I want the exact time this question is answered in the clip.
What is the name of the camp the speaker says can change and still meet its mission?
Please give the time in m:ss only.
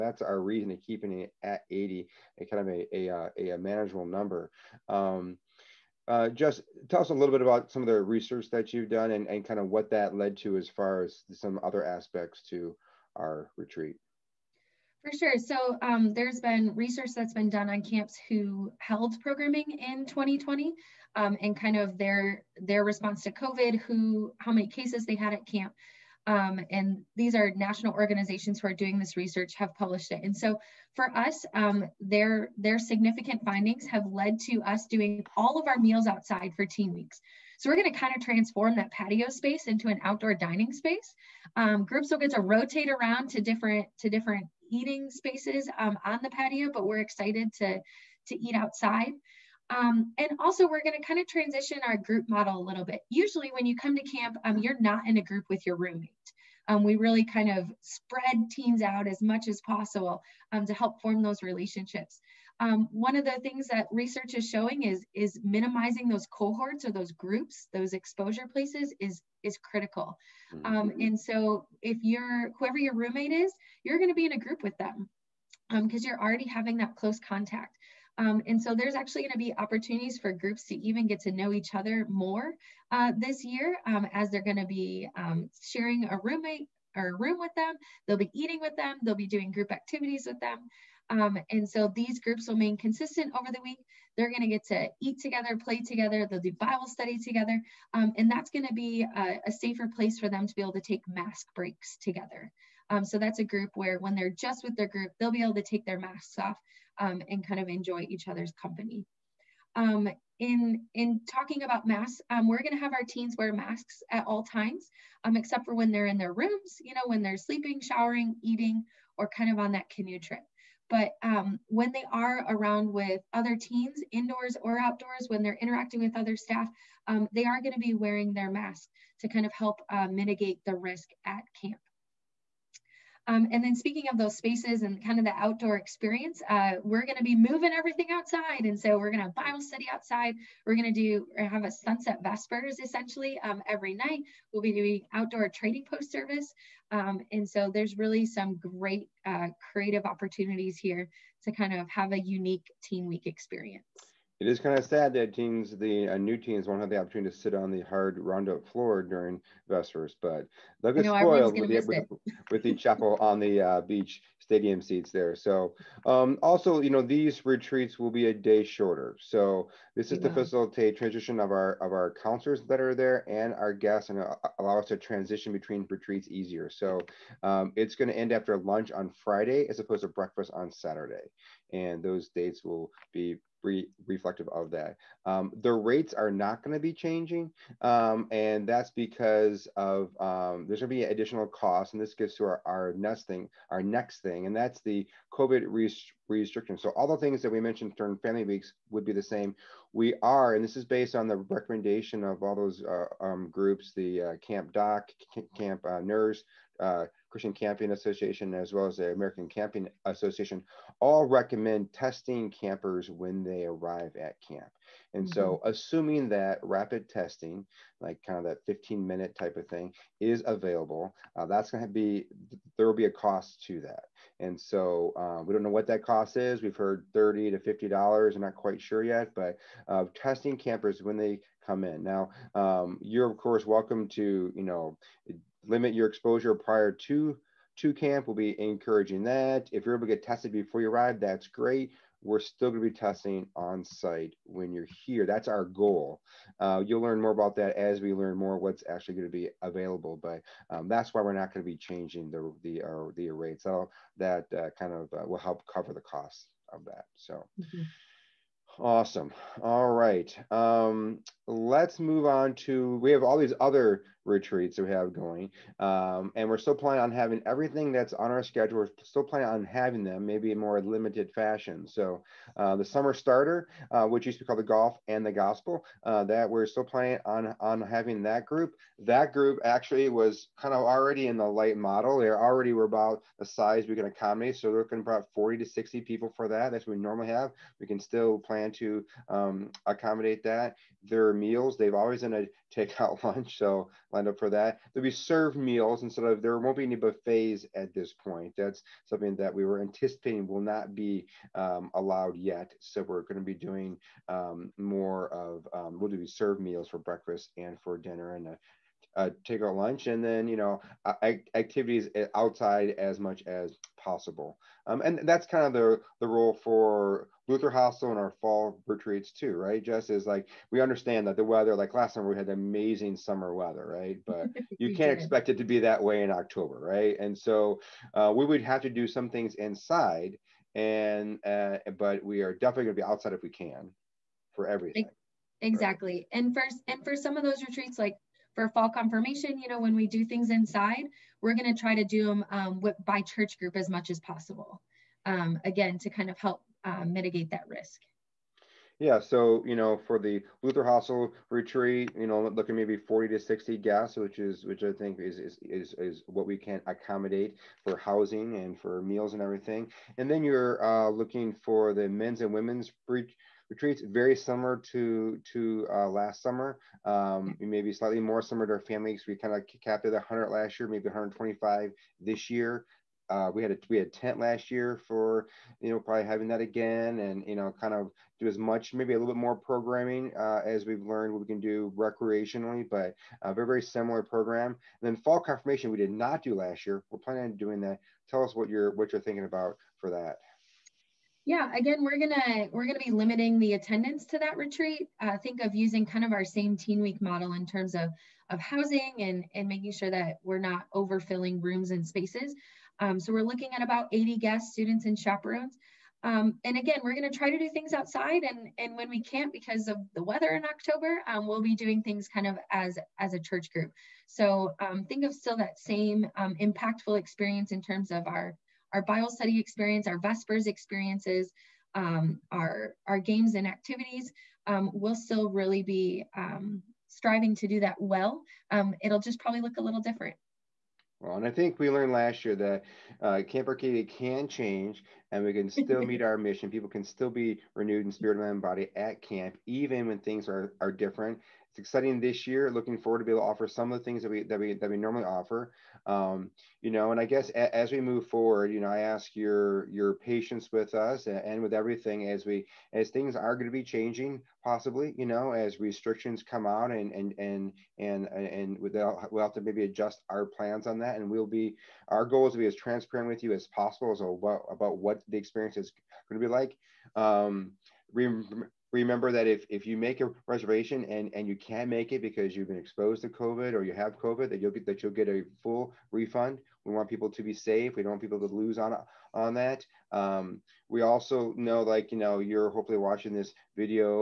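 7:13.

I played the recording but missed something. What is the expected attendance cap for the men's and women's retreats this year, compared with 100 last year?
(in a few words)
125.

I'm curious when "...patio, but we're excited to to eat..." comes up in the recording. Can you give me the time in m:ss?
0:46.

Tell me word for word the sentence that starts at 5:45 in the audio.
Um, again, to kind of help uh, mitigate that risk.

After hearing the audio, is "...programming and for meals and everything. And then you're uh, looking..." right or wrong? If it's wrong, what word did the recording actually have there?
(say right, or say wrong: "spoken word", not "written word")
wrong: "housing", not "programming".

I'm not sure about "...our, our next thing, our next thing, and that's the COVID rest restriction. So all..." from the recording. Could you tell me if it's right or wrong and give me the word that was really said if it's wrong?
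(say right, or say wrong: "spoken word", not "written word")
right.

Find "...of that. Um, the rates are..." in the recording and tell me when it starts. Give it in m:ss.
3:04.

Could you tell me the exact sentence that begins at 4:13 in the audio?
So that uh, kind of uh, will help cover the costs of that.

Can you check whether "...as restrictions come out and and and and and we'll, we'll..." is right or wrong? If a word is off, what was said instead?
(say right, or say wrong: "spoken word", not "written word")
right.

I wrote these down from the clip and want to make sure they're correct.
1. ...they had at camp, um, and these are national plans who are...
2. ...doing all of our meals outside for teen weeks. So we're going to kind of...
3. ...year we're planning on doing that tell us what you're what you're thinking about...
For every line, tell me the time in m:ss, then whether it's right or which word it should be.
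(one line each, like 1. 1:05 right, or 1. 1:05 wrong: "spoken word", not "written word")
1. 0:25 wrong: "organizations", not "plans"
2. 0:34 right
3. 6:26 right.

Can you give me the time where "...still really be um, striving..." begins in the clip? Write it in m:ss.
7:05.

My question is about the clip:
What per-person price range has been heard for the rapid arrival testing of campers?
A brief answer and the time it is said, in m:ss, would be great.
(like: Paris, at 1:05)
$30 to $50, at 3:47.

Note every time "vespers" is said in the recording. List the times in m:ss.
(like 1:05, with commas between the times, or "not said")
2:22, 2:39, 7:00.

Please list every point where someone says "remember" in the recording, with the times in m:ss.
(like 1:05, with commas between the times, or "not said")
7:48.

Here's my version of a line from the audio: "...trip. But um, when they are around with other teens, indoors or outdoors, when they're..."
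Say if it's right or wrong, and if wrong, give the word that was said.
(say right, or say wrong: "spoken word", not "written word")
right.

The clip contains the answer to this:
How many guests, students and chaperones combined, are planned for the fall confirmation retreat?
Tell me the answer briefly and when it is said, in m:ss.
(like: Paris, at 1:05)
80, at 6:44.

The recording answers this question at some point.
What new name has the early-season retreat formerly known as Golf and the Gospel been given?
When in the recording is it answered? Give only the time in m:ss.
4:32.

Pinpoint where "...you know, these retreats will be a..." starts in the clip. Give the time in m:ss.
2:46.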